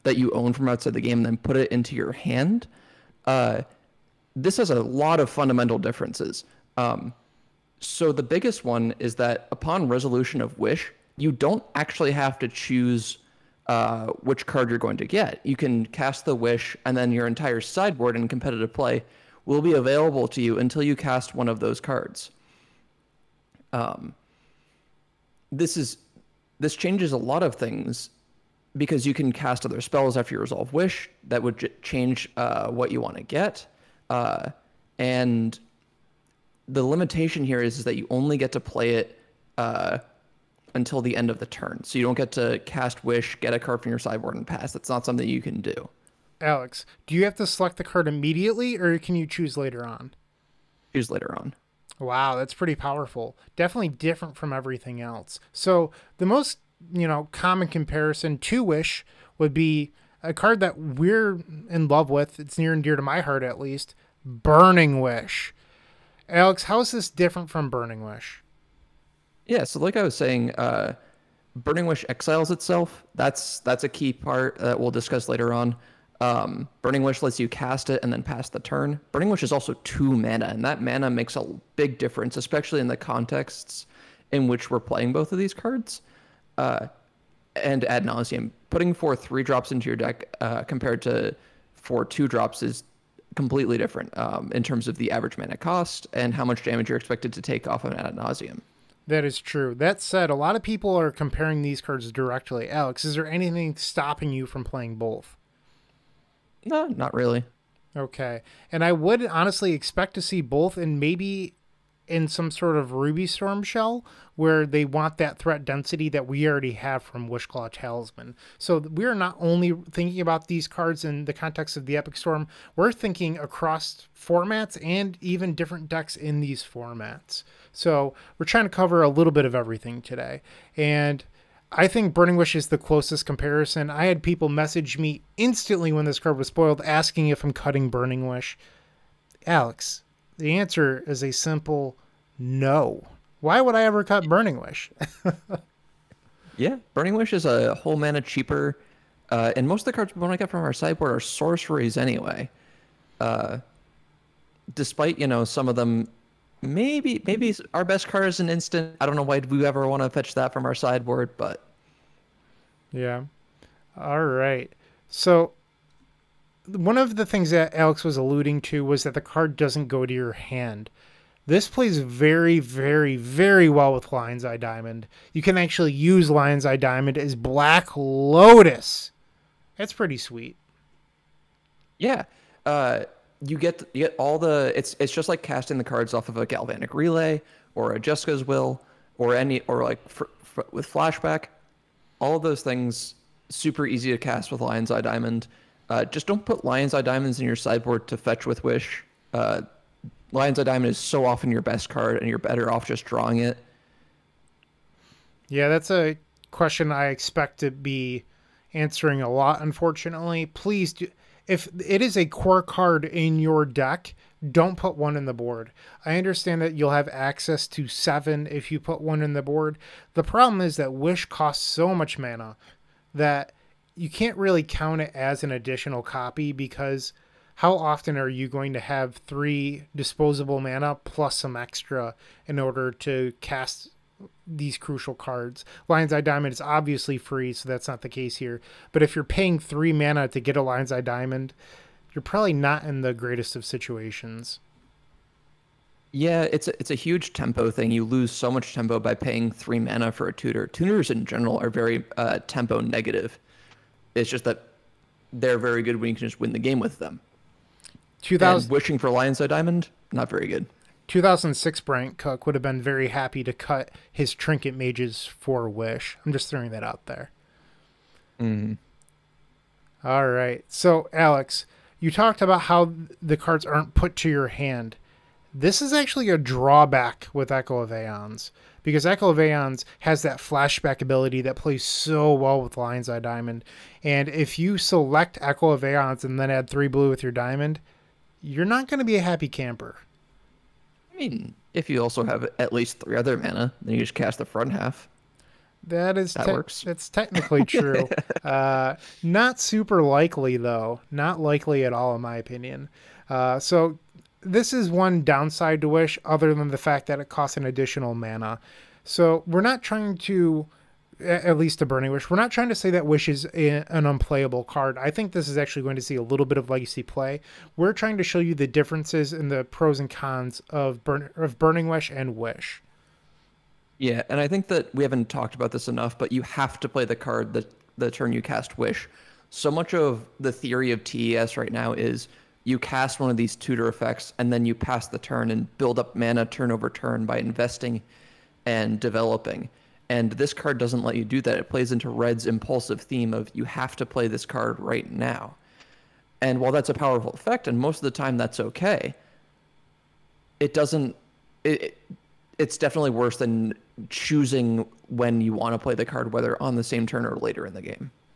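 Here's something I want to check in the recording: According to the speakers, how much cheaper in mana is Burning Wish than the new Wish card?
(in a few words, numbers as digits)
1 mana.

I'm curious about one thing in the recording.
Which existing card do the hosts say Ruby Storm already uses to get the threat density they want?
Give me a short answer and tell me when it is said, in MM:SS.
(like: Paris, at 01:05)
Wishclaw Talisman, at 01:57.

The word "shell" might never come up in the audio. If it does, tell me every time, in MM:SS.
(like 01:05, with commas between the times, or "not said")
01:53.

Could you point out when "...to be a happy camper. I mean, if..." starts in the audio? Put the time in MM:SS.
04:48.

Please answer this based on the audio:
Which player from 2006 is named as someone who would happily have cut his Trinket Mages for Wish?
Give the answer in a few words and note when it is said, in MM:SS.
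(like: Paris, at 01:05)
Bryant Cook, at 04:21.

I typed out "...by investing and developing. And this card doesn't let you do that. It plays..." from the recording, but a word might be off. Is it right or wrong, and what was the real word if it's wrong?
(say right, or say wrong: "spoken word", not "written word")
right.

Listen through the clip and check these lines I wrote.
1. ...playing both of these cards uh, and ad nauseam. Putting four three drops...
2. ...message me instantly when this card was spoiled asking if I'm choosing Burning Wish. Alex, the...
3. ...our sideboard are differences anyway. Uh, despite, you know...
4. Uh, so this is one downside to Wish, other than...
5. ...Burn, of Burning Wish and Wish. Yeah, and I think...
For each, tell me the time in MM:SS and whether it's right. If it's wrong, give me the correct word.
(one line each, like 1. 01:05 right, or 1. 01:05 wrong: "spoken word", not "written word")
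1. 01:24 right
2. 02:14 wrong: "cutting", not "choosing"
3. 02:30 wrong: "sorceries", not "differences"
4. 05:03 right
5. 05:21 right.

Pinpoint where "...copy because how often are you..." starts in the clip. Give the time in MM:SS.
03:46.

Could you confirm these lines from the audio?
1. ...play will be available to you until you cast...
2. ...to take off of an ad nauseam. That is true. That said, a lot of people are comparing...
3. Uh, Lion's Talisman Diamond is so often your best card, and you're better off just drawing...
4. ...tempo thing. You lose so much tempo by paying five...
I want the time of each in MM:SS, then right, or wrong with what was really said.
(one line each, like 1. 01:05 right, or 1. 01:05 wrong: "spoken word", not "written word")
1. 00:18 right
2. 01:37 right
3. 03:19 wrong: "Eye", not "Talisman"
4. 04:07 wrong: "three", not "five".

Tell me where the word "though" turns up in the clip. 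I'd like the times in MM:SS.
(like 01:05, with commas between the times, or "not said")
05:00.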